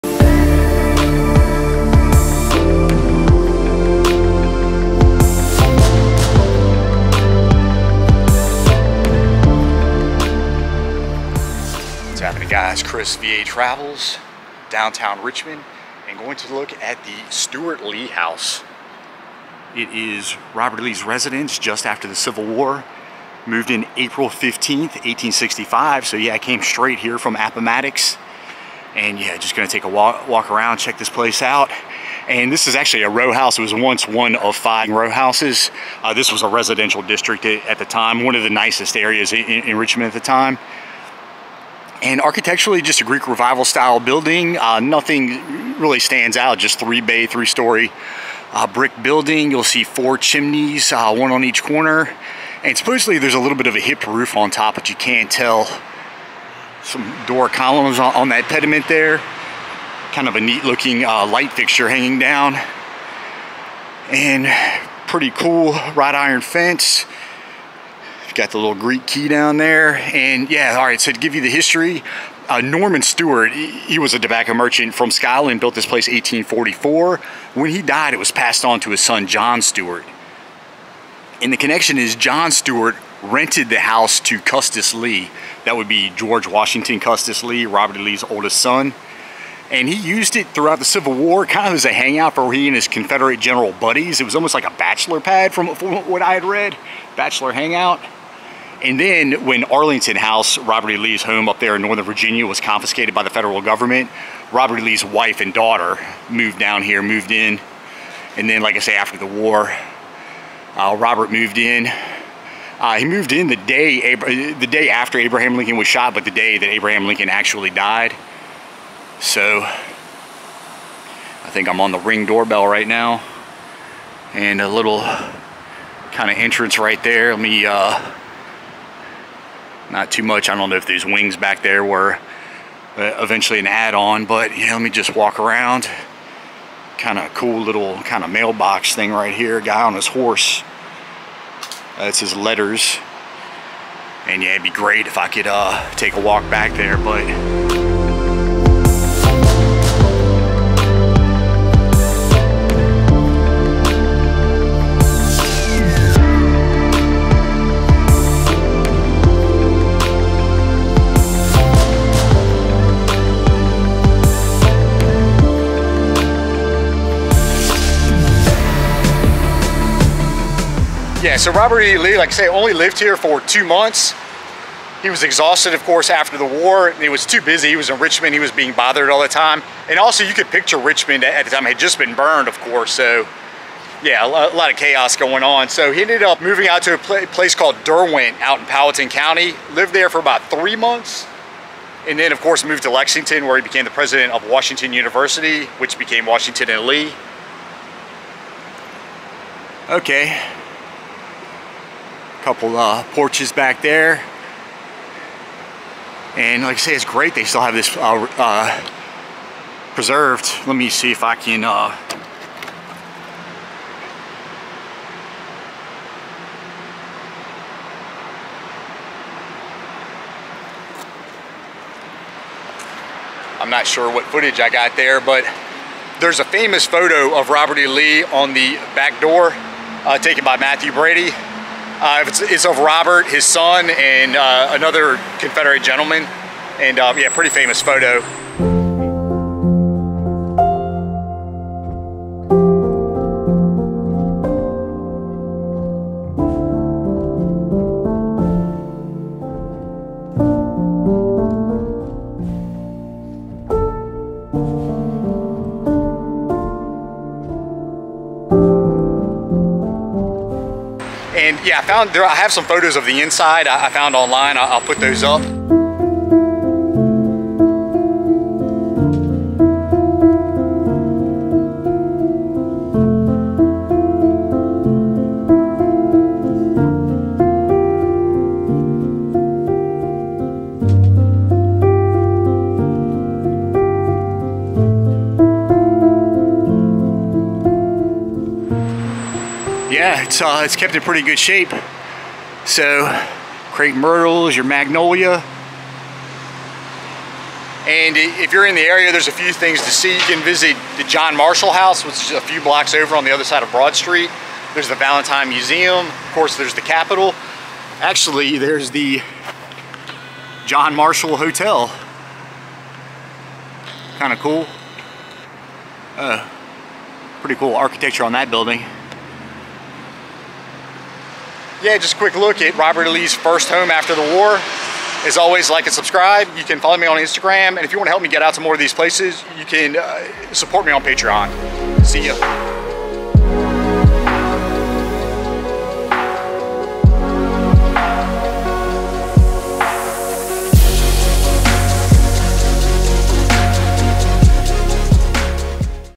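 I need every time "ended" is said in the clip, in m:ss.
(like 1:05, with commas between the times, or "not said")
3:06.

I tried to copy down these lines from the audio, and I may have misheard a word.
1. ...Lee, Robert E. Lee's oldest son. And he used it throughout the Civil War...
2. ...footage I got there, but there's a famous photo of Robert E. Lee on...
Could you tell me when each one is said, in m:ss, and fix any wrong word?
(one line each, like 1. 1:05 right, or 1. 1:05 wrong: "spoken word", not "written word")
1. 1:27 right
2. 3:44 right.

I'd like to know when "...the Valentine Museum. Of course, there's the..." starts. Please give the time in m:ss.
5:04.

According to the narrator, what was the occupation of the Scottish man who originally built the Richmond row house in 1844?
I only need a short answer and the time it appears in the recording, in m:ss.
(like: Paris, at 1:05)
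Tobacco merchant, at 1:14.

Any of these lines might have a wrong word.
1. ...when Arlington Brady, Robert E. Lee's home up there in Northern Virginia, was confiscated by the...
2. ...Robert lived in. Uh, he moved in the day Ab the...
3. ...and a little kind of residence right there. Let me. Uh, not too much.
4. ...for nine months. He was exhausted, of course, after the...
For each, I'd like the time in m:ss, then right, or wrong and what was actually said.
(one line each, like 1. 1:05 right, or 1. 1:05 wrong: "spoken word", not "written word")
1. 1:39 wrong: "House", not "Brady"
2. 1:50 wrong: "moved", not "lived"
3. 2:04 wrong: "entrance", not "residence"
4. 2:53 wrong: "two", not "nine".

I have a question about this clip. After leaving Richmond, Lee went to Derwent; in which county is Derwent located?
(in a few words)
Powhatan County.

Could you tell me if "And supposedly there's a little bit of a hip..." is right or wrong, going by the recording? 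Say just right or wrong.
right.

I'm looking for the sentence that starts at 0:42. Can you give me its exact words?
And architecturally, just a Greek revival style building.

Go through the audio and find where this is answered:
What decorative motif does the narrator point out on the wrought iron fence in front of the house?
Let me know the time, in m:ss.
1:08.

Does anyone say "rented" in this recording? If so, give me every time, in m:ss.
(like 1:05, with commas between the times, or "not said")
1:23.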